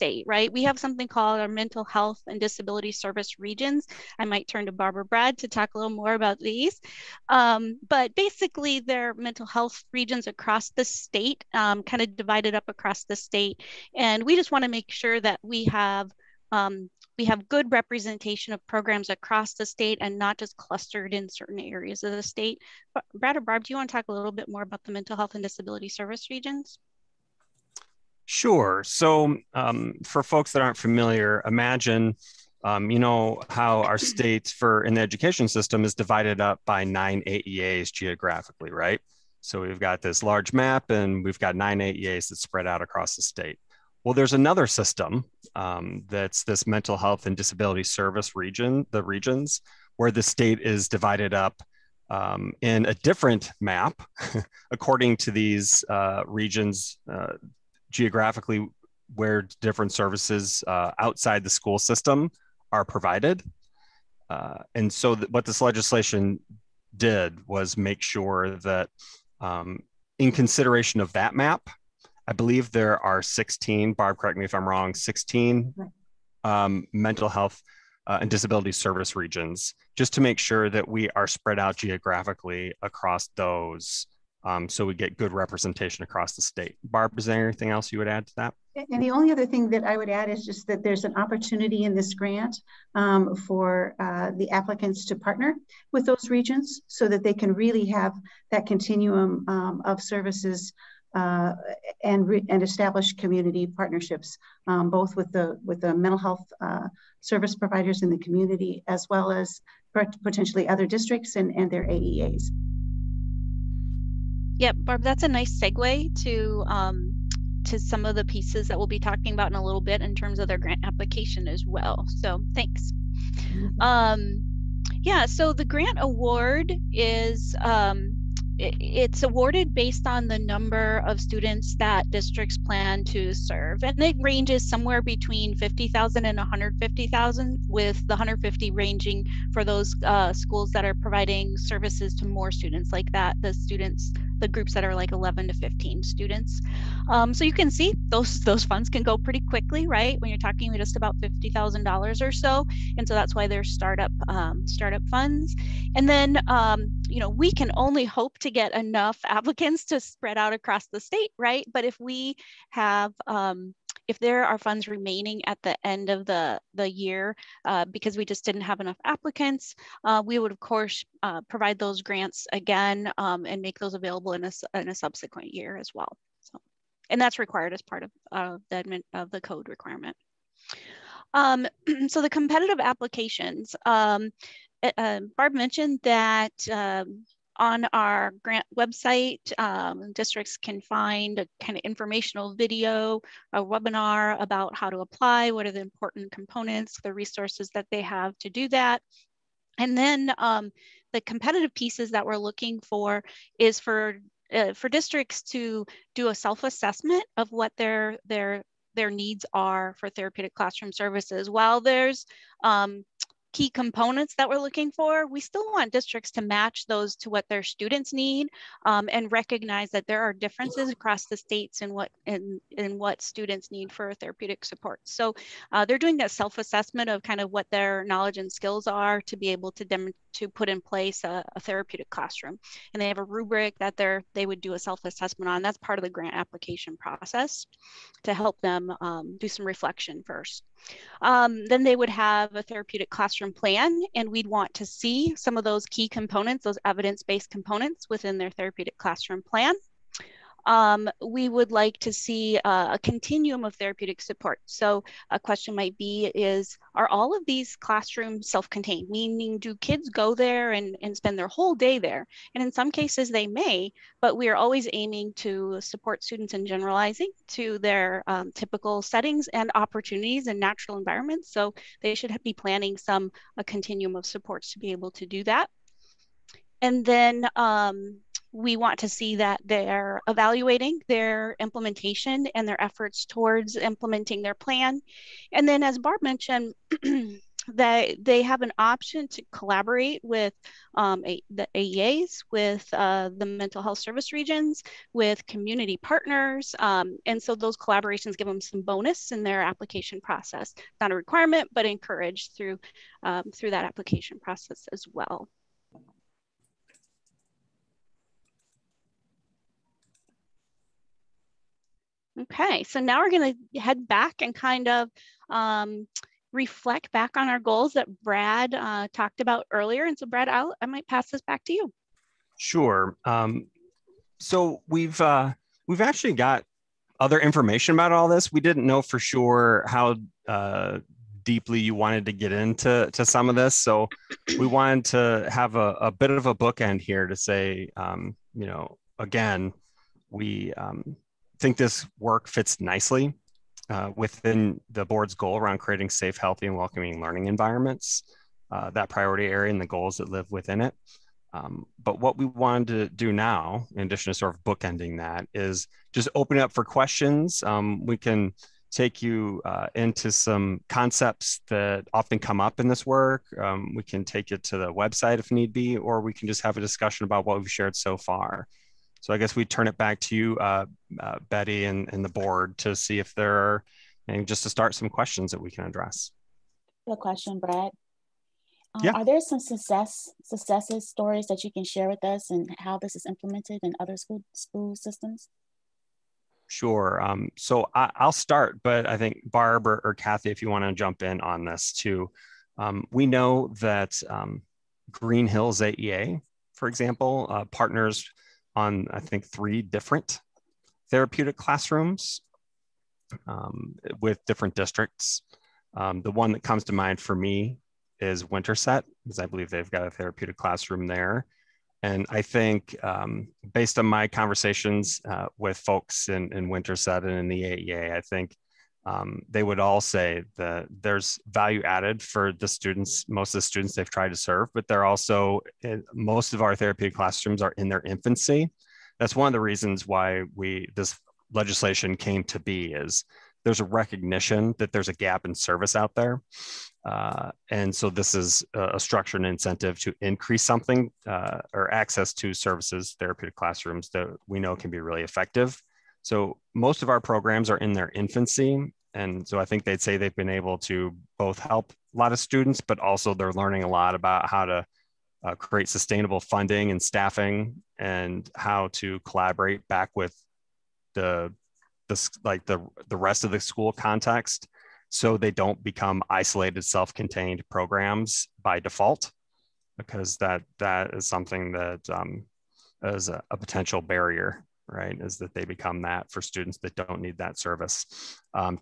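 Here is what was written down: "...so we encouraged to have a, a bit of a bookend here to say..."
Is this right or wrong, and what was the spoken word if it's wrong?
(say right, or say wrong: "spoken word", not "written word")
wrong: "wanted", not "encouraged".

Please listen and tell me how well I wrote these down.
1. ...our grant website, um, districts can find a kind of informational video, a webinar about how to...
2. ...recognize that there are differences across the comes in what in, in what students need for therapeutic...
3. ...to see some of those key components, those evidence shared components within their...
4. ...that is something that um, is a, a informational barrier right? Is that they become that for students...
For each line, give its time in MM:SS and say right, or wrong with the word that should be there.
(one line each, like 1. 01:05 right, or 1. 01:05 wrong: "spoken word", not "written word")
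1. 03:07 right
2. 03:39 wrong: "states", not "comes"
3. 04:04 wrong: "based", not "shared"
4. 07:50 wrong: "potential", not "informational".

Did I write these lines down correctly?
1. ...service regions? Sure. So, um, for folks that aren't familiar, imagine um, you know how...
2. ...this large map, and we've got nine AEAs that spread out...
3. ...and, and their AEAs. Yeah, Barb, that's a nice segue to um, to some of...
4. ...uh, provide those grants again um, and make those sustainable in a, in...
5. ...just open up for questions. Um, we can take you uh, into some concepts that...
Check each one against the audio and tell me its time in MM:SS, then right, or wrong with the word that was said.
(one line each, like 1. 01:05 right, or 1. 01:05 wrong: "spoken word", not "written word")
1. 00:25 right
2. 00:40 right
3. 01:51 right
4. 02:51 wrong: "available", not "sustainable"
5. 05:56 right.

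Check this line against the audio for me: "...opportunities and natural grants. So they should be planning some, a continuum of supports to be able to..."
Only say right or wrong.
wrong.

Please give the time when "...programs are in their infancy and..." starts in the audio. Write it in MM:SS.
07:27.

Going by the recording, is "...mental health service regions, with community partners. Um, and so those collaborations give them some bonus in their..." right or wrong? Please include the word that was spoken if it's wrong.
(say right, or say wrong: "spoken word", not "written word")
right.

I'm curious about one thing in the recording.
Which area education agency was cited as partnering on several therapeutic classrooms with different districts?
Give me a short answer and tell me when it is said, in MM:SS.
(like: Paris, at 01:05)
Green Hills AEA, at 06:35.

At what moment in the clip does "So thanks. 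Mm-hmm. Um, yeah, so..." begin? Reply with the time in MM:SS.
02:02.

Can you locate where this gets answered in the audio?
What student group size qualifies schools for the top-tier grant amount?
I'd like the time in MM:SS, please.
02:25.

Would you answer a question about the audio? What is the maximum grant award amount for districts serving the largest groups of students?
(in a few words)
$150,000.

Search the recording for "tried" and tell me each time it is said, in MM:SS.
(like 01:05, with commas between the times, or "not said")
07:04.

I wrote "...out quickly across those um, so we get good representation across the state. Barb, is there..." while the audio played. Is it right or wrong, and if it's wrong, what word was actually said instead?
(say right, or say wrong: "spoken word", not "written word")
wrong: "geographically", not "quickly".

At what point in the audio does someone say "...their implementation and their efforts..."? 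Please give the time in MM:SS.
04:41.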